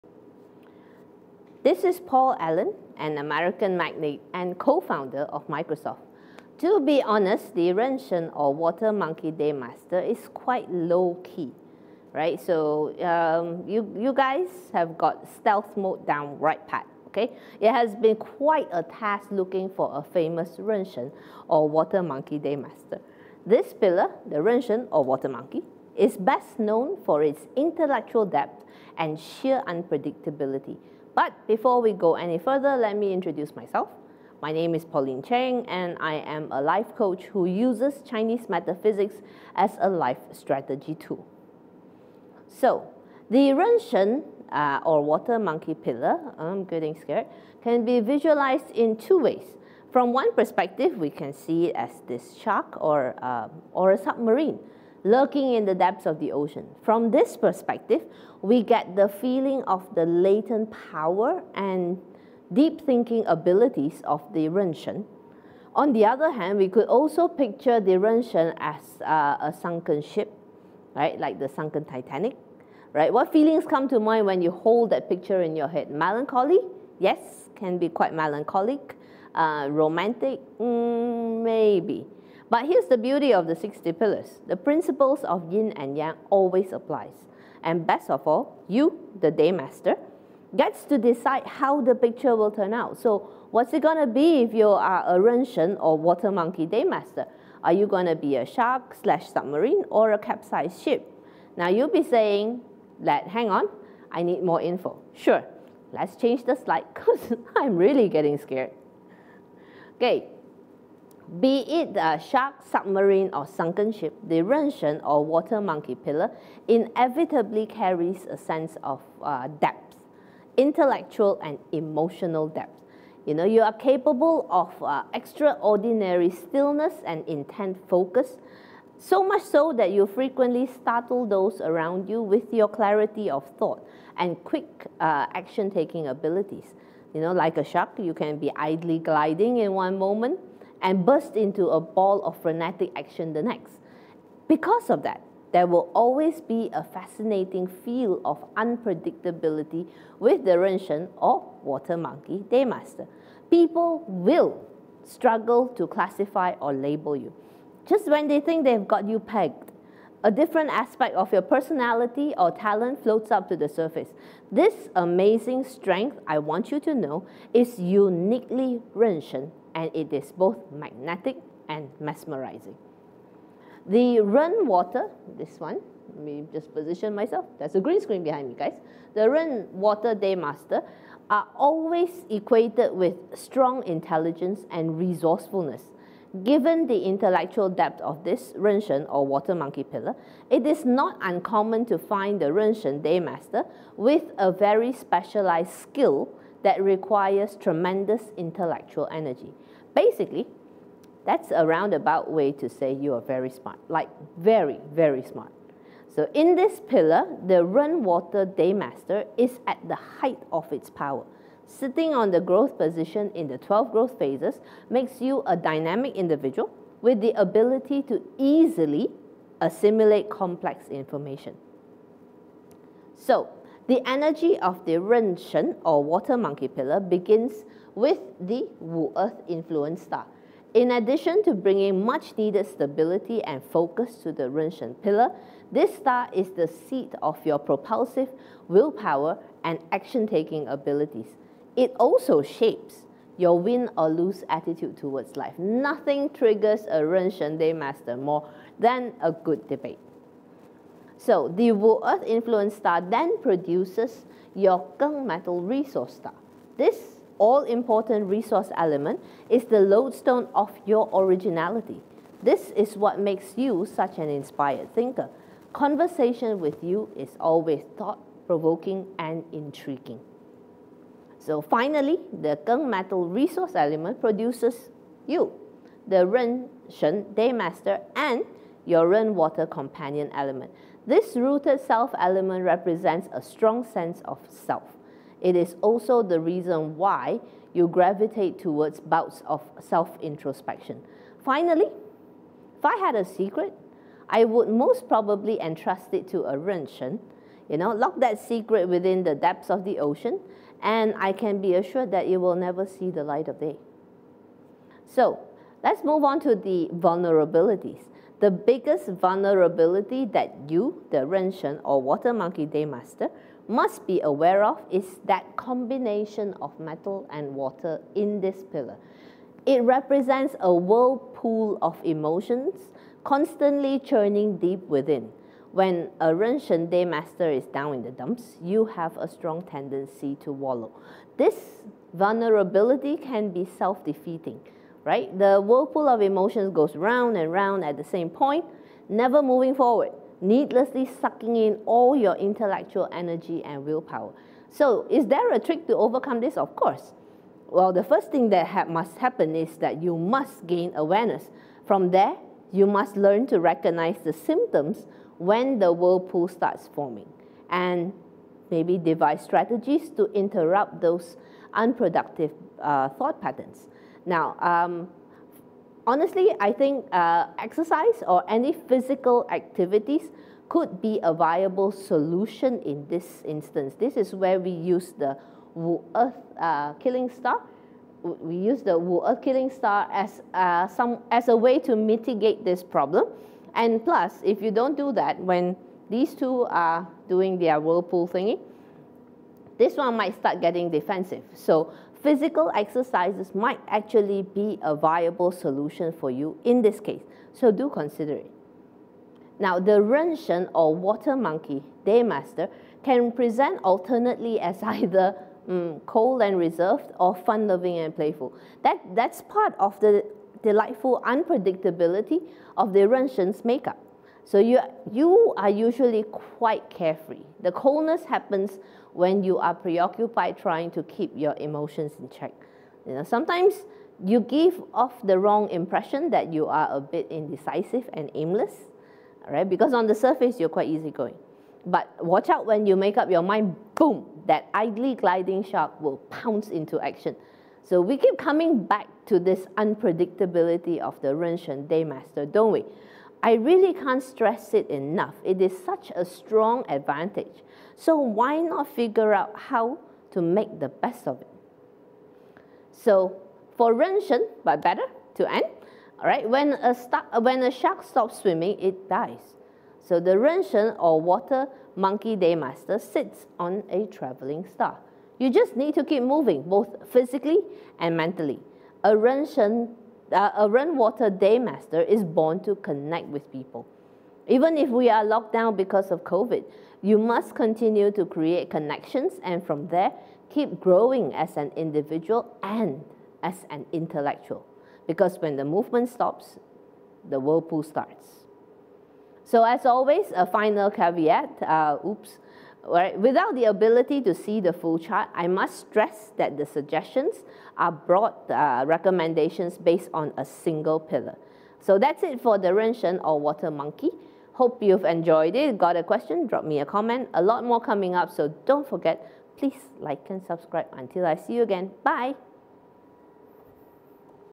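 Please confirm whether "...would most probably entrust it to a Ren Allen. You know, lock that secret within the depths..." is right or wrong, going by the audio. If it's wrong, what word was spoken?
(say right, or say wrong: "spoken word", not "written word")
wrong: "Shen", not "Allen".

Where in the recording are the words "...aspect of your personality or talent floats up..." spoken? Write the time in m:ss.
2:40.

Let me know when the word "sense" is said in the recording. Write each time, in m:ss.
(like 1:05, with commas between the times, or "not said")
1:58, 4:43.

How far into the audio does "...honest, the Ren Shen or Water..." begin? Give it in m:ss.
0:07.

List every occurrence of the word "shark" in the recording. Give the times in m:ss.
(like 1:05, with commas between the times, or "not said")
0:52, 1:38, 1:52, 2:17, 7:15, 7:37.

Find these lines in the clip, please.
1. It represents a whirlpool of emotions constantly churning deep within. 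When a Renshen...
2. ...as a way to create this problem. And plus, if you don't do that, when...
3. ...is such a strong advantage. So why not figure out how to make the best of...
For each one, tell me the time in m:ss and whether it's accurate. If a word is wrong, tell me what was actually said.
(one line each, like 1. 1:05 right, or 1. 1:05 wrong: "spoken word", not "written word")
1. 5:19 right
2. 6:21 wrong: "mitigate", not "create"
3. 7:25 right.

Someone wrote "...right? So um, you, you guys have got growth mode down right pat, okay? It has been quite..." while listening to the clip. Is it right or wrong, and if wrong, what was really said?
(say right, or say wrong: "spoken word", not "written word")
wrong: "stealth", not "growth".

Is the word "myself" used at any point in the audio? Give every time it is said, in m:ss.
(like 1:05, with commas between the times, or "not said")
0:33, 2:57.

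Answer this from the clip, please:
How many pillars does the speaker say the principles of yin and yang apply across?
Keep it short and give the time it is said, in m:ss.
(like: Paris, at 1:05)
60, at 1:23.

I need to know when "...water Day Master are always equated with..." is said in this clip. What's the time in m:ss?
2:59.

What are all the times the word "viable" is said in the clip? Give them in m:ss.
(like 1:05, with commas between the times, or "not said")
6:11, 6:34.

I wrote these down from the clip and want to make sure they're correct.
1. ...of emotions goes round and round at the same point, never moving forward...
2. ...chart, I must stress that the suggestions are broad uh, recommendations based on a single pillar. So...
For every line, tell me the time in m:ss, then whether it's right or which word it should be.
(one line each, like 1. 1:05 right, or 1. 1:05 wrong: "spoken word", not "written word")
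1. 5:36 right
2. 8:14 right.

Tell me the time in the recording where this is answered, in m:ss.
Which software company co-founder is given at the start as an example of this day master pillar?
0:01.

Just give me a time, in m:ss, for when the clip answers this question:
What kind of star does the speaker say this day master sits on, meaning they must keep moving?
7:44.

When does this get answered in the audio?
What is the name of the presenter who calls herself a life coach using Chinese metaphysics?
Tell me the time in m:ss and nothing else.
0:34.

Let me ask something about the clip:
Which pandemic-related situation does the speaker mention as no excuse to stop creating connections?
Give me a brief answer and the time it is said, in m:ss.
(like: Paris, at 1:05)
COVID, at 7:56.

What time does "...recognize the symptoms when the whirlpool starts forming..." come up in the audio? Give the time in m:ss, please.
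5:53.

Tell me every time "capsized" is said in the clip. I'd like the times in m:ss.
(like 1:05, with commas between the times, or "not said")
1:40.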